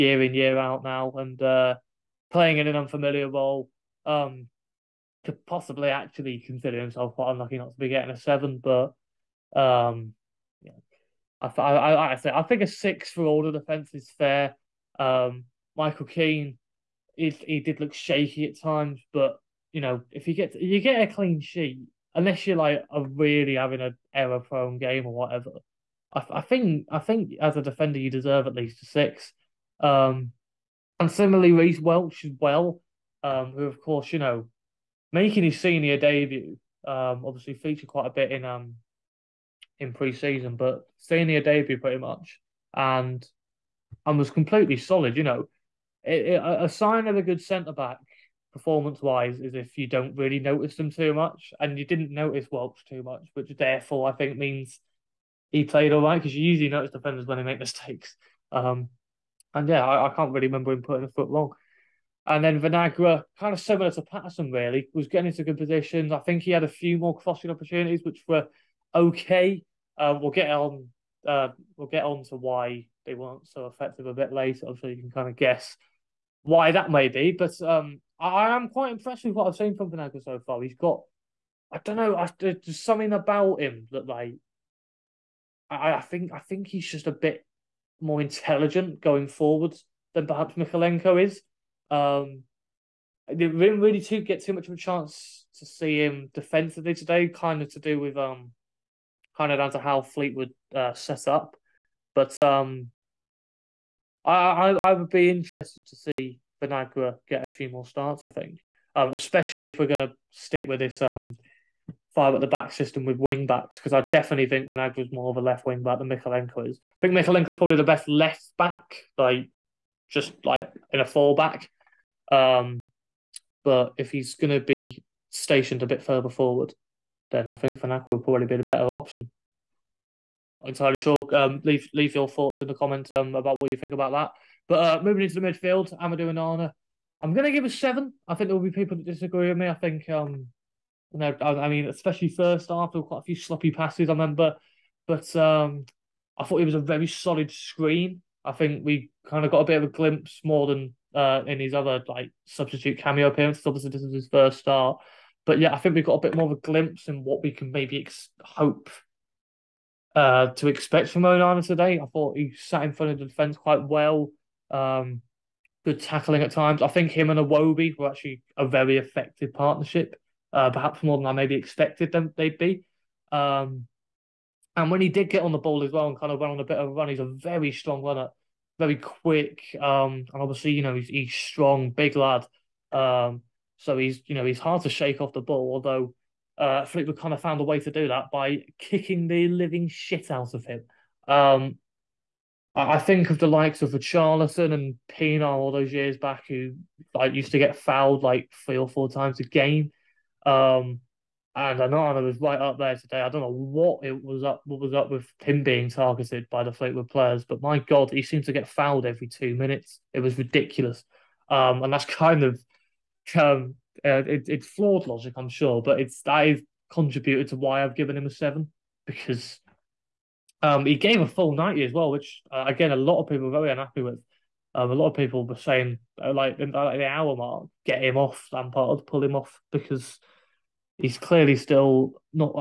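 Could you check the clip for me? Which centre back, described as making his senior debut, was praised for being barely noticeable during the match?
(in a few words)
Reese Welch.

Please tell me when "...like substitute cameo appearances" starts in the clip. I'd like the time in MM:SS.
02:32.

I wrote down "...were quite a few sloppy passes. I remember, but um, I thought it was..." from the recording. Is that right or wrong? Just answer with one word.
right.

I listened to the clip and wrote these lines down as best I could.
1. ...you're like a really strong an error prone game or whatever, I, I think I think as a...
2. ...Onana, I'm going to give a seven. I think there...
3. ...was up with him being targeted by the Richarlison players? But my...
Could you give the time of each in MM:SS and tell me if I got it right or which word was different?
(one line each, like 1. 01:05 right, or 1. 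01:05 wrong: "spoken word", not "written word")
1. 00:22 wrong: "having", not "strong"
2. 02:16 right
3. 03:24 wrong: "Fleetwood", not "Richarlison".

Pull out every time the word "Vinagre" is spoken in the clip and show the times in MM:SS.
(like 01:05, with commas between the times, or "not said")
01:02, 01:19, 01:46, 01:54, 02:07.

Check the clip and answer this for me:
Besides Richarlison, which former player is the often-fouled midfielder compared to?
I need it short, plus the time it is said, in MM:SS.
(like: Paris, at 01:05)
Pienaar, at 03:15.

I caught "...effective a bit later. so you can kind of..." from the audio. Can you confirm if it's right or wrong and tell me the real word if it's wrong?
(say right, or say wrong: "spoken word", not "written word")
right.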